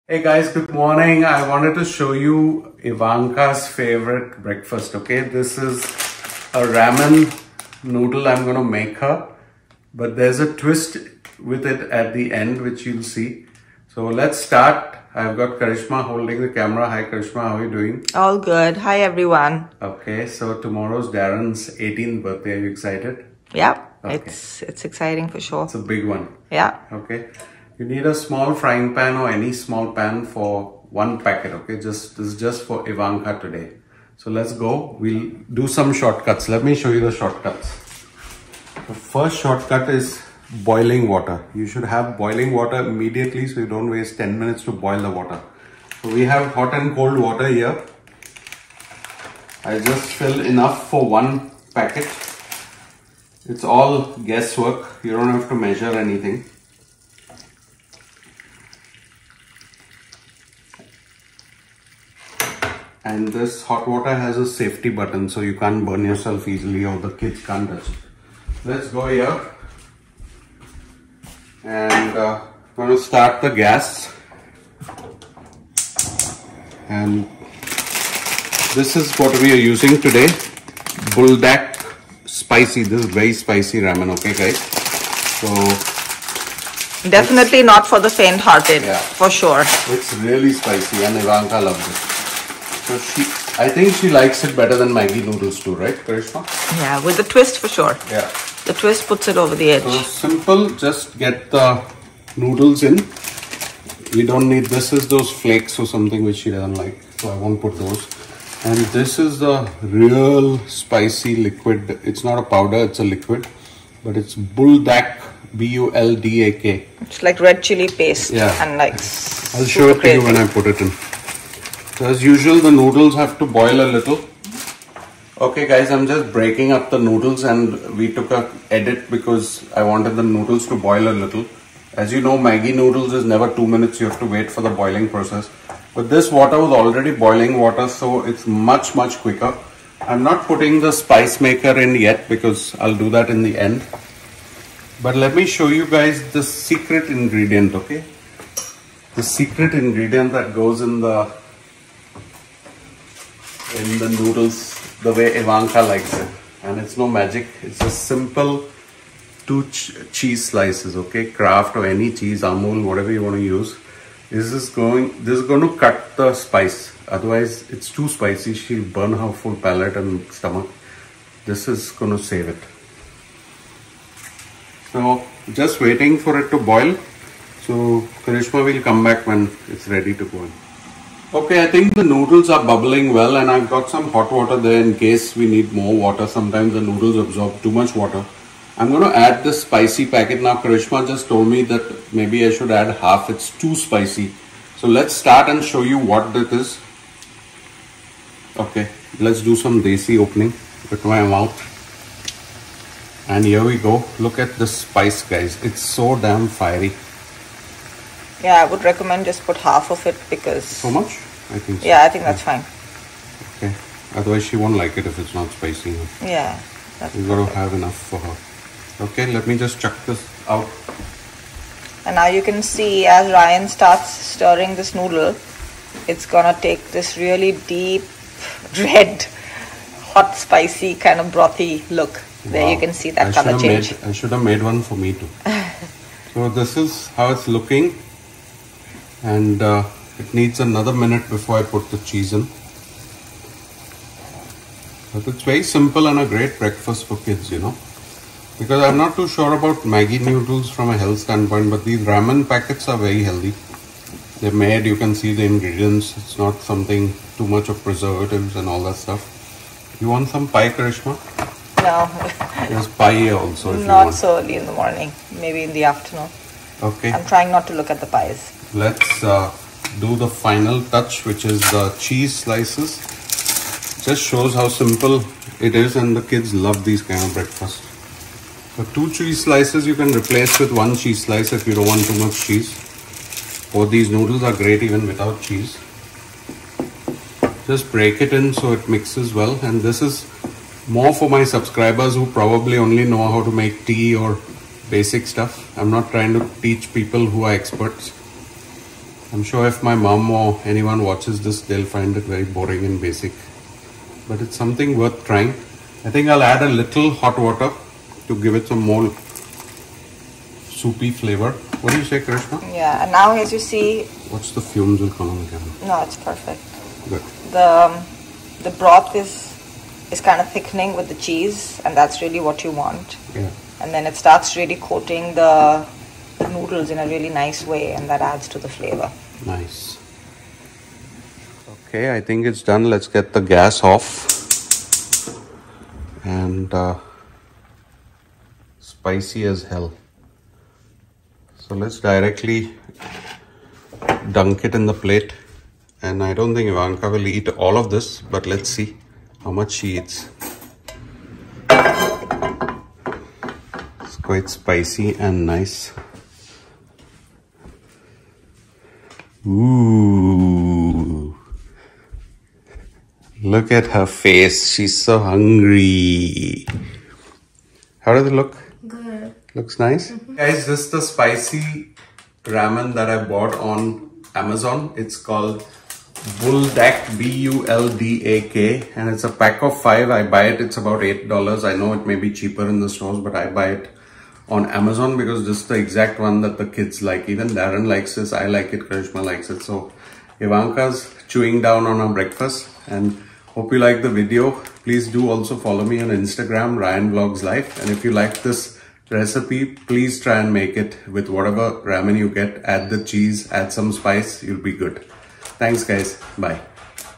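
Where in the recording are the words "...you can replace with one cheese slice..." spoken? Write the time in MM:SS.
04:39.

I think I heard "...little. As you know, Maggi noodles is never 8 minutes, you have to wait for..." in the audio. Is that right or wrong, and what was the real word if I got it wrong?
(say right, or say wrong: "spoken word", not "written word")
wrong: "2", not "8".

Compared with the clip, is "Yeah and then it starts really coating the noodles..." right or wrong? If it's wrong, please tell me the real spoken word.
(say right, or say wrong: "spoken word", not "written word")
right.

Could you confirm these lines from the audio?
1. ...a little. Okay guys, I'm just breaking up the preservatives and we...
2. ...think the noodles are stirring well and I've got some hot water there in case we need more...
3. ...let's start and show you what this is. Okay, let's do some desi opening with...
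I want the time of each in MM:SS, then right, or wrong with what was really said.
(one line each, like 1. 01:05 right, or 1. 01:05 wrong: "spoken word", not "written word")
1. 02:03 wrong: "noodles", not "preservatives"
2. 03:01 wrong: "bubbling", not "stirring"
3. 03:14 right.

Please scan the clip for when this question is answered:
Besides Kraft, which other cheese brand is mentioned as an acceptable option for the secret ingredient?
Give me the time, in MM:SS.
02:42.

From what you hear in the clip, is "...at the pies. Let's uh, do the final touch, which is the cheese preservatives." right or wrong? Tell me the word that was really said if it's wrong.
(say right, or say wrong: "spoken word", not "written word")
wrong: "slices", not "preservatives".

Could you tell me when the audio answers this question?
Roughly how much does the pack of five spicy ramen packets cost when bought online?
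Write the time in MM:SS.
06:21.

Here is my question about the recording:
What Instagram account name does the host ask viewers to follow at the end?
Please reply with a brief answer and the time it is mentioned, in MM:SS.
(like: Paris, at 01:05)
Ryan Vlogs Life, at 06:36.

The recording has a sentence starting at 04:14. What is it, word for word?
They're made, you can see the ingredients.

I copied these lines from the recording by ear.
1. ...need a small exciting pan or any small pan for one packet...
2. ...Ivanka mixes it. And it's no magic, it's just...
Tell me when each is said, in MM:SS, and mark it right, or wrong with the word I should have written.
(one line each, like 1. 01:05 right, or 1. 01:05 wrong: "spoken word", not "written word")
1. 00:27 wrong: "frying", not "exciting"
2. 02:35 wrong: "likes", not "mixes".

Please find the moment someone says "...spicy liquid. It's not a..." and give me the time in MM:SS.
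01:50.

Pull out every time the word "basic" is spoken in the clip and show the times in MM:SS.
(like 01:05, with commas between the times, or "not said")
04:54, 05:03.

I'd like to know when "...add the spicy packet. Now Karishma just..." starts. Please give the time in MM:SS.
03:09.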